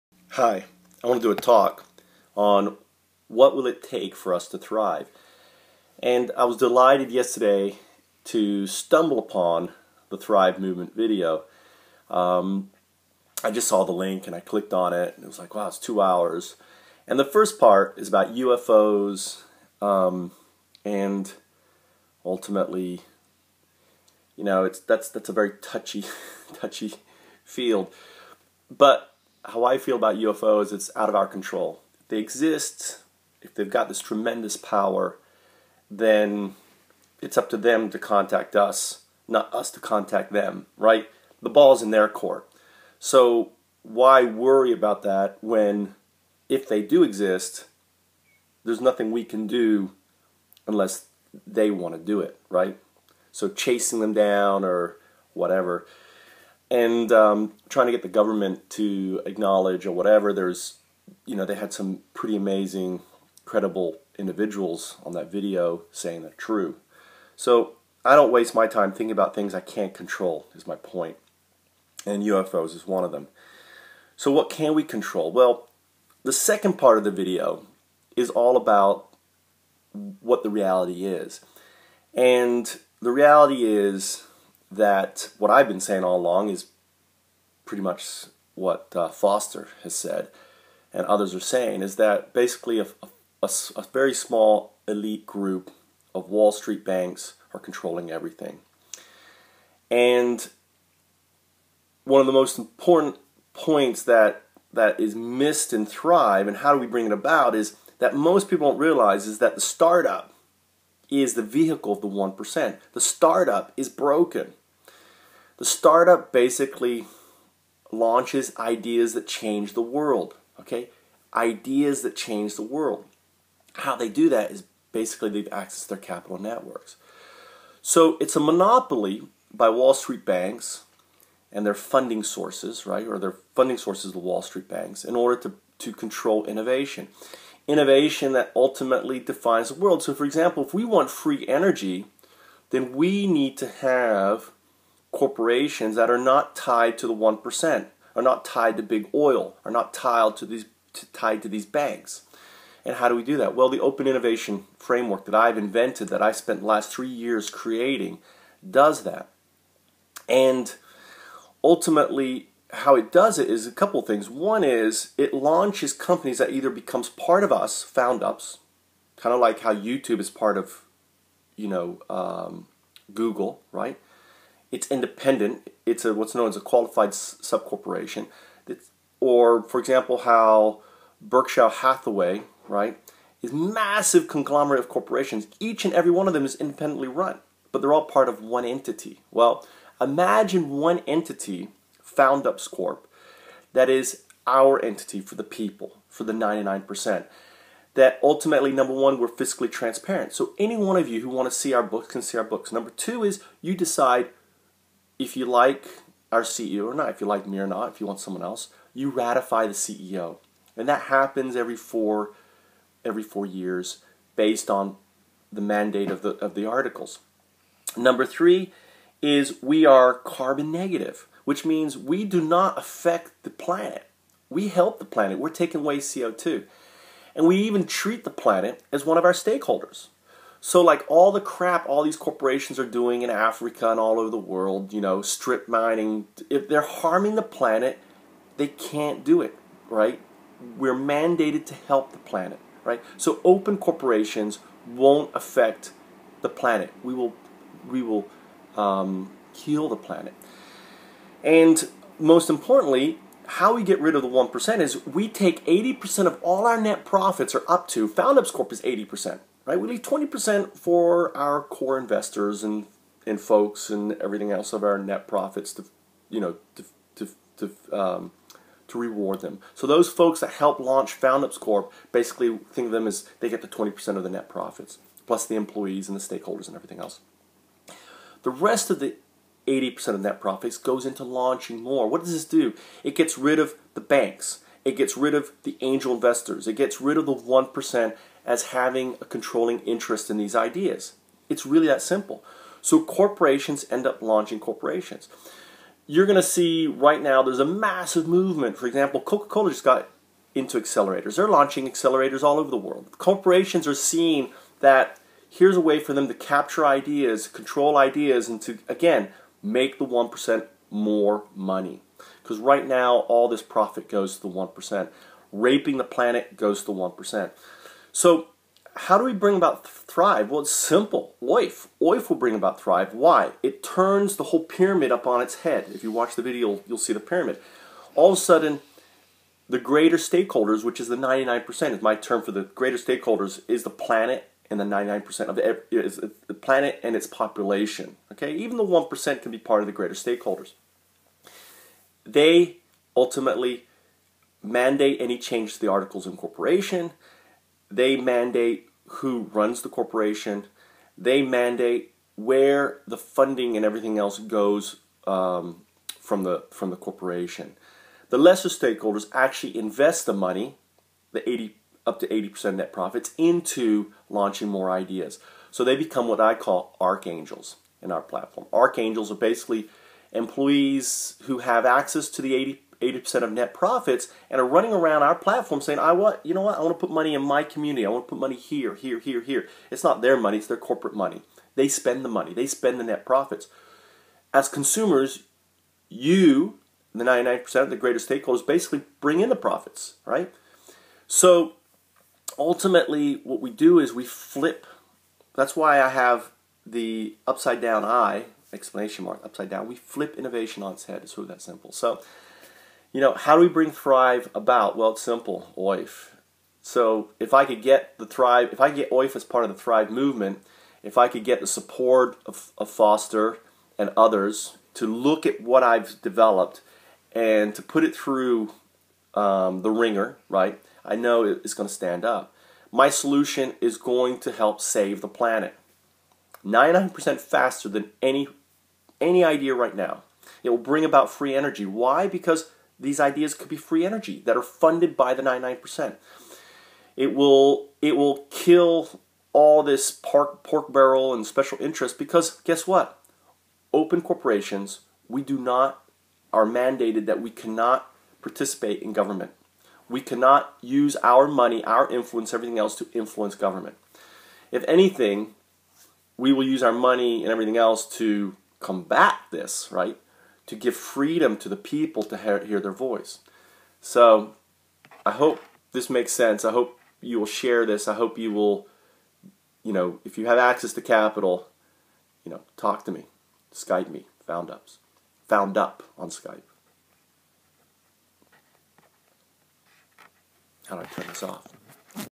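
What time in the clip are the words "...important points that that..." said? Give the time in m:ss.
1:42.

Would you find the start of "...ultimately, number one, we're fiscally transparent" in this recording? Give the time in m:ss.
3:18.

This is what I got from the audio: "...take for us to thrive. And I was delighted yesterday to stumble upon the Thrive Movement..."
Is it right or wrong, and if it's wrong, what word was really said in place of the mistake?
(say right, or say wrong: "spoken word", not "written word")
right.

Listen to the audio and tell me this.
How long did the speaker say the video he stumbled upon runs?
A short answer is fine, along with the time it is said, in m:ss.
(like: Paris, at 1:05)
2 hours, at 0:15.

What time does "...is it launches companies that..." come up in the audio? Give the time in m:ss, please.
2:44.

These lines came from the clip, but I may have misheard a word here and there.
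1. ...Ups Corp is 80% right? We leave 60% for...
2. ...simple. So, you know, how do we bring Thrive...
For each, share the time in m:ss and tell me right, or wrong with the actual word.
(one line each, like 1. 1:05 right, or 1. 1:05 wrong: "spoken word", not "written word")
1. 4:18 wrong: "20", not "60"
2. 6:41 right.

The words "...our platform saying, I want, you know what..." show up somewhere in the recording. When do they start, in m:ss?
6:15.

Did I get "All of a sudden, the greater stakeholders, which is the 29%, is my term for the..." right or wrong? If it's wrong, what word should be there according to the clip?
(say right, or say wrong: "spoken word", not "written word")
wrong: "99", not "29".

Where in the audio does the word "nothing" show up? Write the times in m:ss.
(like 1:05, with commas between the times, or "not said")
0:48.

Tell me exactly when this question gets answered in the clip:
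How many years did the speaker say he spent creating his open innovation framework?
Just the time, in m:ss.
2:36.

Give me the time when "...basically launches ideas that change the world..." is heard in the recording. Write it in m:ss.
1:56.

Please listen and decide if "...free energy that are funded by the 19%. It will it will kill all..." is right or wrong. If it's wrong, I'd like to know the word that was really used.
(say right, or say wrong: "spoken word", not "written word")
wrong: "99", not "19".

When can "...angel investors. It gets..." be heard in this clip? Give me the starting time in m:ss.
4:45.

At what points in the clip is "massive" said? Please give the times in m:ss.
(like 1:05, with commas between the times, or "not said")
3:03, 4:57.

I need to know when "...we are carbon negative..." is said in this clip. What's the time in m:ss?
3:39.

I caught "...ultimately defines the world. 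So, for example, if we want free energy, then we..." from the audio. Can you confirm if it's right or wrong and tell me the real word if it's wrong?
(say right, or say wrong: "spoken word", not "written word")
right.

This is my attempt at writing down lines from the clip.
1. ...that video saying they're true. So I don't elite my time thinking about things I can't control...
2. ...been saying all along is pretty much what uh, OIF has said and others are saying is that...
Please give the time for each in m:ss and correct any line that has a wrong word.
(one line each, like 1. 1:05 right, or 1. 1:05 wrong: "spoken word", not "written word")
1. 1:05 wrong: "waste", not "elite"
2. 1:25 wrong: "Foster", not "OIF".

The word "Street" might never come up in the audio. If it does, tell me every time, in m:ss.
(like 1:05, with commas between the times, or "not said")
1:36, 2:09, 2:14.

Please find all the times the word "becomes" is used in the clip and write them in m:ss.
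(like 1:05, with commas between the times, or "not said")
2:46, 6:05.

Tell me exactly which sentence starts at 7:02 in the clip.
My solution is going to help save the planet.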